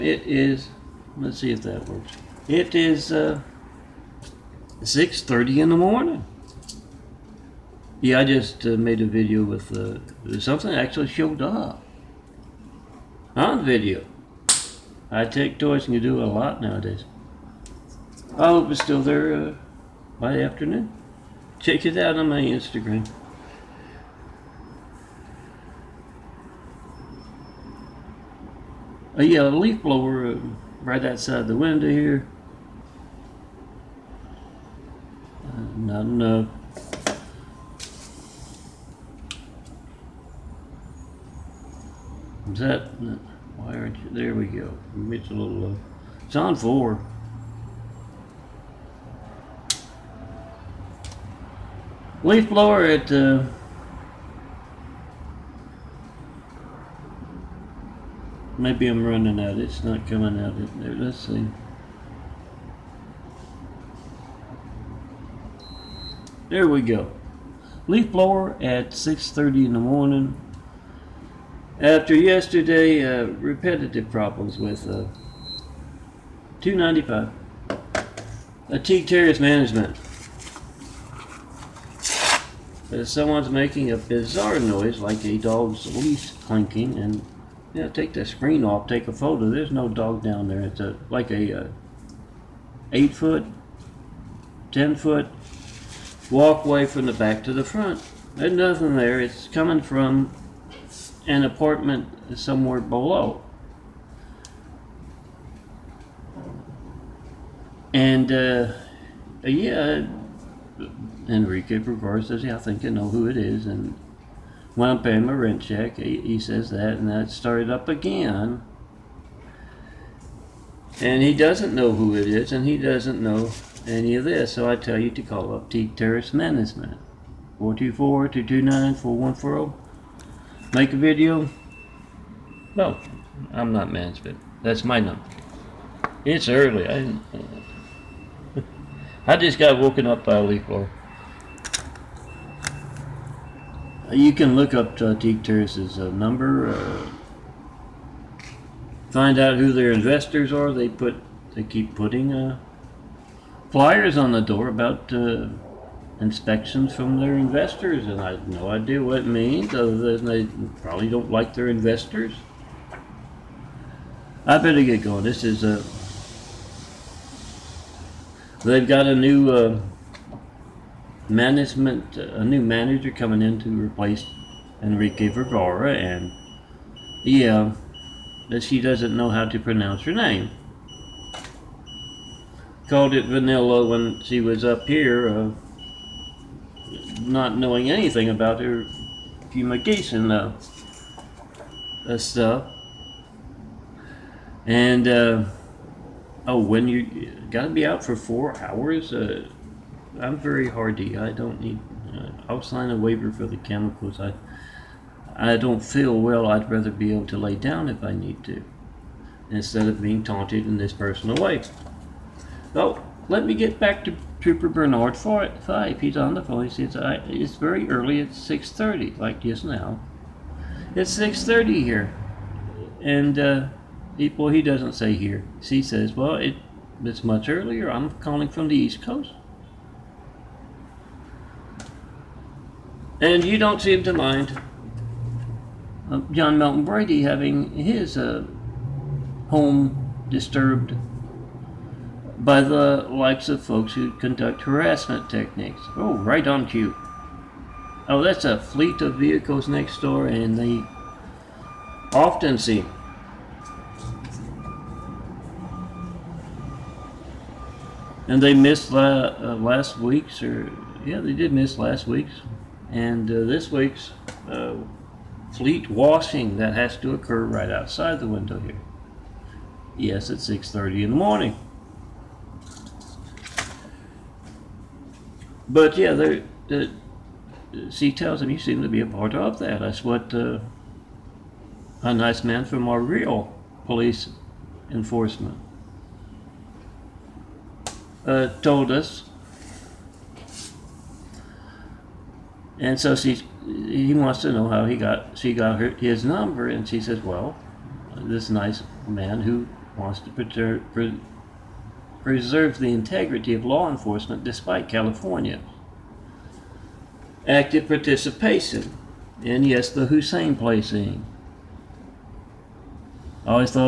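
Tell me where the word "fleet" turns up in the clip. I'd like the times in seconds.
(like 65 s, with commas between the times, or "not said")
248 s, 265 s.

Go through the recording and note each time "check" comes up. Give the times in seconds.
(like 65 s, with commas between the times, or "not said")
21 s, 115 s.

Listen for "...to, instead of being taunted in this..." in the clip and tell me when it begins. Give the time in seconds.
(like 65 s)
208 s.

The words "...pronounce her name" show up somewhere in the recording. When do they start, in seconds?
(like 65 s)
179 s.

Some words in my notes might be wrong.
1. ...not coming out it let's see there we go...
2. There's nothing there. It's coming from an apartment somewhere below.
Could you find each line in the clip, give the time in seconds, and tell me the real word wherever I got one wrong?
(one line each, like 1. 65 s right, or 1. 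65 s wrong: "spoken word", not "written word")
1. 59 s right
2. 98 s right.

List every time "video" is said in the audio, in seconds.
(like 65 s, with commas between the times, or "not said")
9 s, 13 s, 130 s.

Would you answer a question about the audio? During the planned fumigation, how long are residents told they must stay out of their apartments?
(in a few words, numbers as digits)
4 hours.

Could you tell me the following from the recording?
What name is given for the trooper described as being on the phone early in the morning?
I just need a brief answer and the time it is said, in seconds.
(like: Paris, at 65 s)
Bernard Fife, at 214 s.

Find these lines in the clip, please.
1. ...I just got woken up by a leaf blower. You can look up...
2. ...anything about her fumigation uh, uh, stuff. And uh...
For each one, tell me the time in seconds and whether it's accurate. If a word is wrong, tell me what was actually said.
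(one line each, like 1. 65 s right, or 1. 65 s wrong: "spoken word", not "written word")
1. 139 s right
2. 187 s right.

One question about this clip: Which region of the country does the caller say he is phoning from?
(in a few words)
East Coast.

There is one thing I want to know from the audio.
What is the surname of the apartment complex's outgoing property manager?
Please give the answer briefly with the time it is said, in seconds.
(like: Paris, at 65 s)
Vergara, at 175 s.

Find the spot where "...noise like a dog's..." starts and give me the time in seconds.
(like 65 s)
84 s.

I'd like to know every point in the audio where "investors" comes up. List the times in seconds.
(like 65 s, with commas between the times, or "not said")
149 s, 157 s, 161 s.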